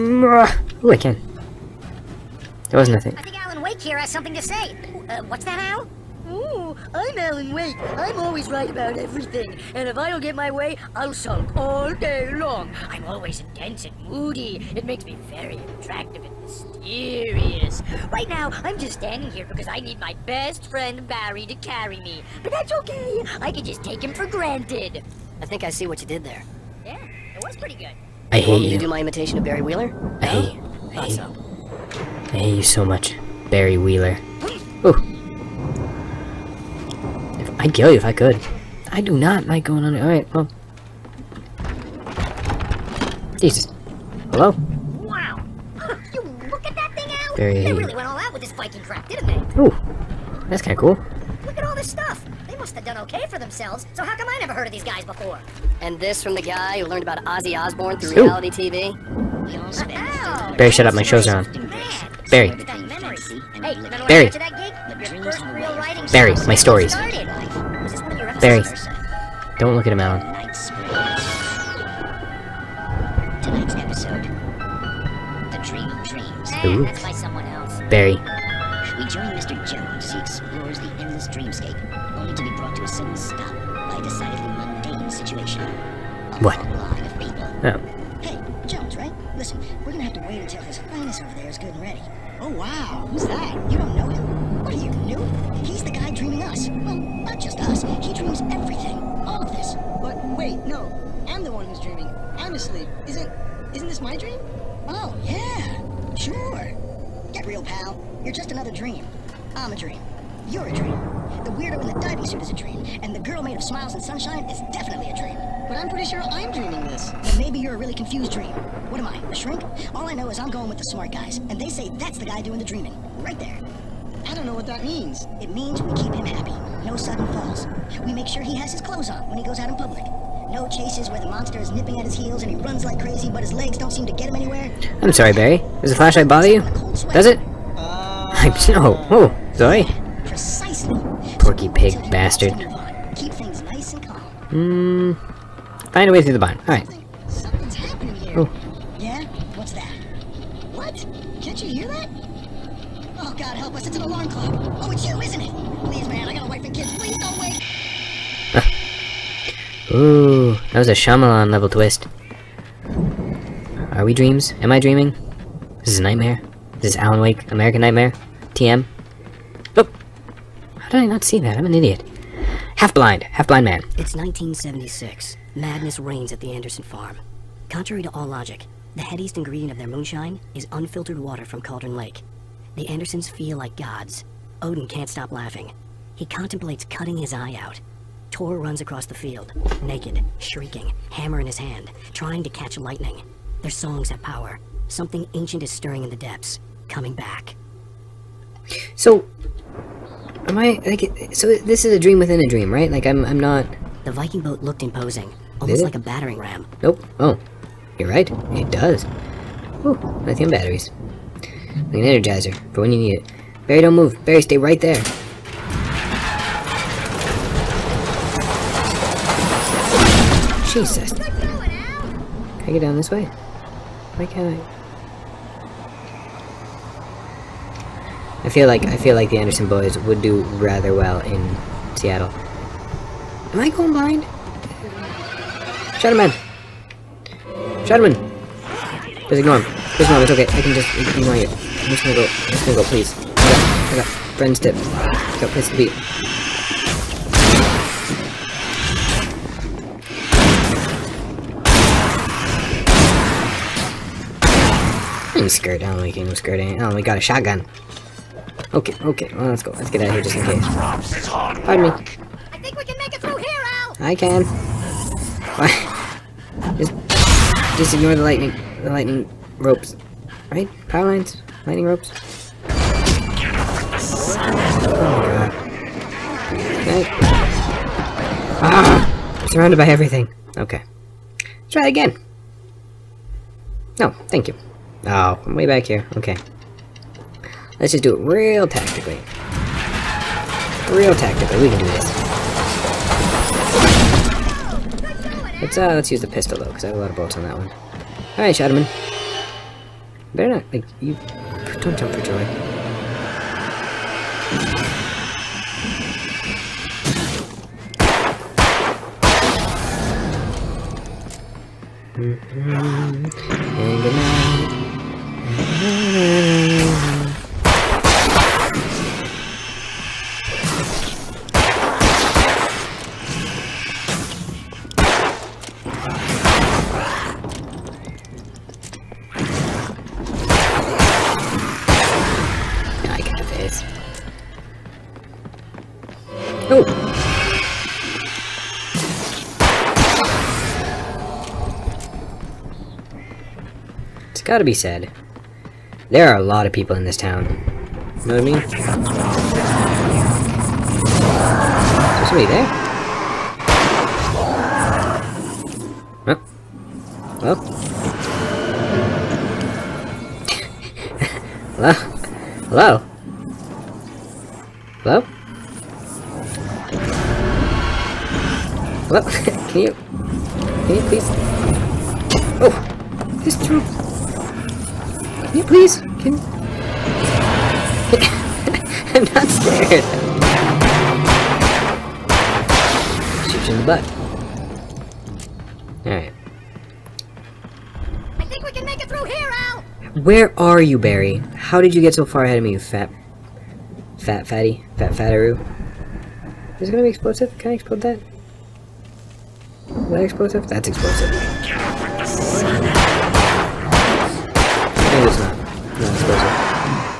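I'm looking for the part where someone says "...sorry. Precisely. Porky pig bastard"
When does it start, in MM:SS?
02:19.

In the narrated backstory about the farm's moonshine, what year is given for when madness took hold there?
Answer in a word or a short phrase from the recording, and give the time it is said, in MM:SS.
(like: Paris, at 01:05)
1976, at 02:54.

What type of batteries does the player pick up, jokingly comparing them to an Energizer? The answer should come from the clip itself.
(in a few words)
lithium batteries.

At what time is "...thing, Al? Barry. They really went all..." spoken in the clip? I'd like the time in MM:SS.
00:46.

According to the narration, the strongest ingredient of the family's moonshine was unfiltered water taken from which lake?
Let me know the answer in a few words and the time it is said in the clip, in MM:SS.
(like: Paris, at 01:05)
Cauldron Lake, at 03:01.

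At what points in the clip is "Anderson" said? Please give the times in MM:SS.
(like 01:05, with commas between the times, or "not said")
02:56, 03:02, 03:49.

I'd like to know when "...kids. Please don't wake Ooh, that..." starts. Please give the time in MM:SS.
02:36.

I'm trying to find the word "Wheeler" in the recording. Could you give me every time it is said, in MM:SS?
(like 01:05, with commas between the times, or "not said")
00:29, 00:33.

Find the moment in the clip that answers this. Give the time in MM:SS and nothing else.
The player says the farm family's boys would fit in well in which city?
03:51.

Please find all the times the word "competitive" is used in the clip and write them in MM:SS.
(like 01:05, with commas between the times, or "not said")
not said.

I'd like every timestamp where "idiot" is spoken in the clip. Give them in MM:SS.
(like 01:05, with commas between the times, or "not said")
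02:51.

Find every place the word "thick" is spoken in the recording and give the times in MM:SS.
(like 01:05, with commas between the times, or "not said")
not said.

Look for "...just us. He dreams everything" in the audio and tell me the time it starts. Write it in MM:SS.
01:37.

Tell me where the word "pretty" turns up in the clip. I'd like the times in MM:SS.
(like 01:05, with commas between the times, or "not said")
00:27, 01:55.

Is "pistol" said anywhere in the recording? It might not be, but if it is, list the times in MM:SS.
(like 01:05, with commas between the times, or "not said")
04:56.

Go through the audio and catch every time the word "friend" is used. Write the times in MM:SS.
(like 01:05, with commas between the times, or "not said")
00:20, 04:04.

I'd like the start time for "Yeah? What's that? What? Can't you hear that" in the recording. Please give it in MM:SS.
02:28.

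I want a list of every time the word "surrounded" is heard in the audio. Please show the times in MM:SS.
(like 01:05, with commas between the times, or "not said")
04:39.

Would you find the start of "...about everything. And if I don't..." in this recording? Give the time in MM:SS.
00:08.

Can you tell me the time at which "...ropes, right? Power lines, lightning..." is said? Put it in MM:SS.
04:29.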